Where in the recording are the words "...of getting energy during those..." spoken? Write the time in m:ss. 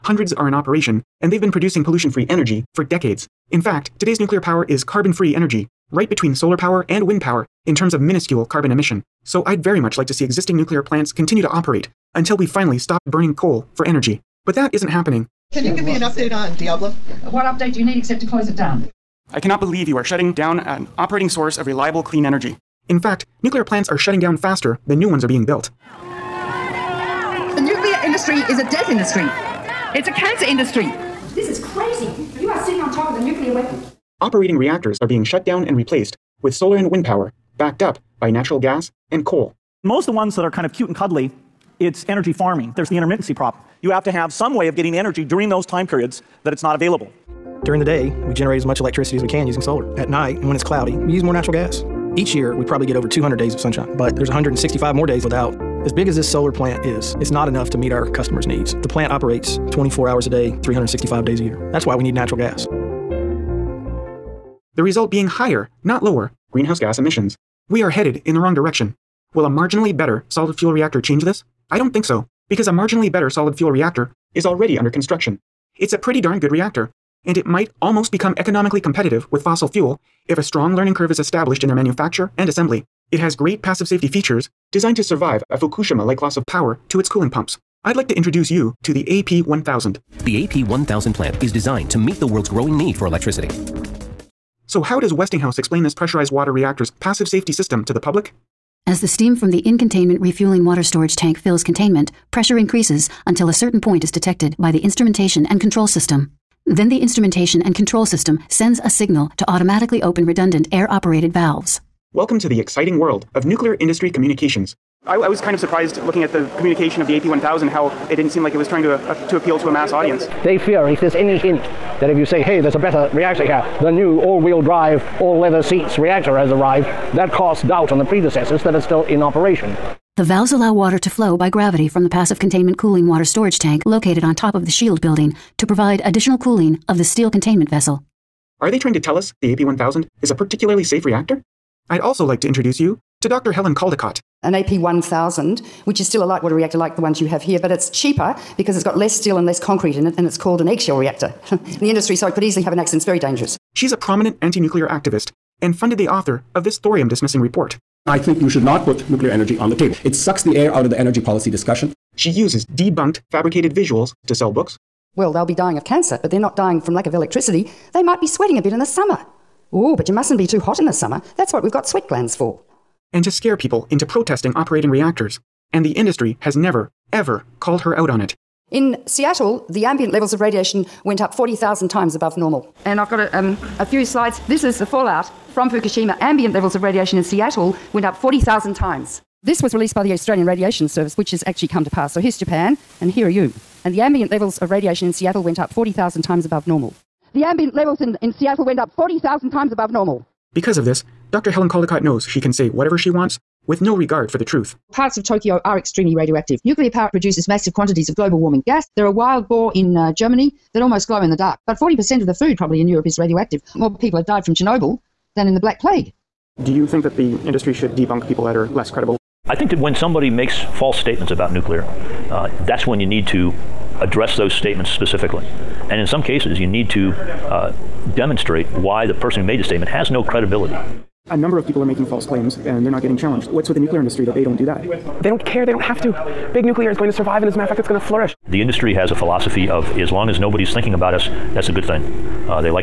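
0:44.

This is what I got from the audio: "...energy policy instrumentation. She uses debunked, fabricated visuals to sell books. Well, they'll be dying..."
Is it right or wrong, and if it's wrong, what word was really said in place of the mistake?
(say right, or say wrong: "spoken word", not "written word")
wrong: "discussion", not "instrumentation".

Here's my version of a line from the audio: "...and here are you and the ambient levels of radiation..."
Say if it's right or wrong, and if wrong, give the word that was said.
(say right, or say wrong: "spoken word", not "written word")
right.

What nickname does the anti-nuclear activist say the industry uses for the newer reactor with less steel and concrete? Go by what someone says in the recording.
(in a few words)
eggshell reactor.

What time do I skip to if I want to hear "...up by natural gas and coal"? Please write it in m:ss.
0:37.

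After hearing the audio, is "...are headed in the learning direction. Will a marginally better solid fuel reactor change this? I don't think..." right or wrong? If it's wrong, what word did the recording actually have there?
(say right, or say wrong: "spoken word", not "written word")
wrong: "wrong", not "learning".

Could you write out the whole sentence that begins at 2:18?
Are they trying to tell us the AP 1000 is a particularly safe reactor?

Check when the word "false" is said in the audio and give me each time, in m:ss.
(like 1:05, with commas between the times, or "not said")
3:40, 3:52.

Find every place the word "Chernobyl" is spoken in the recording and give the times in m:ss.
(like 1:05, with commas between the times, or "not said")
3:34.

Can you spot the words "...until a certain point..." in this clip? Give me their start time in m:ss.
1:43.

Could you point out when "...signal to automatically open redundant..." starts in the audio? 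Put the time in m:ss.
1:48.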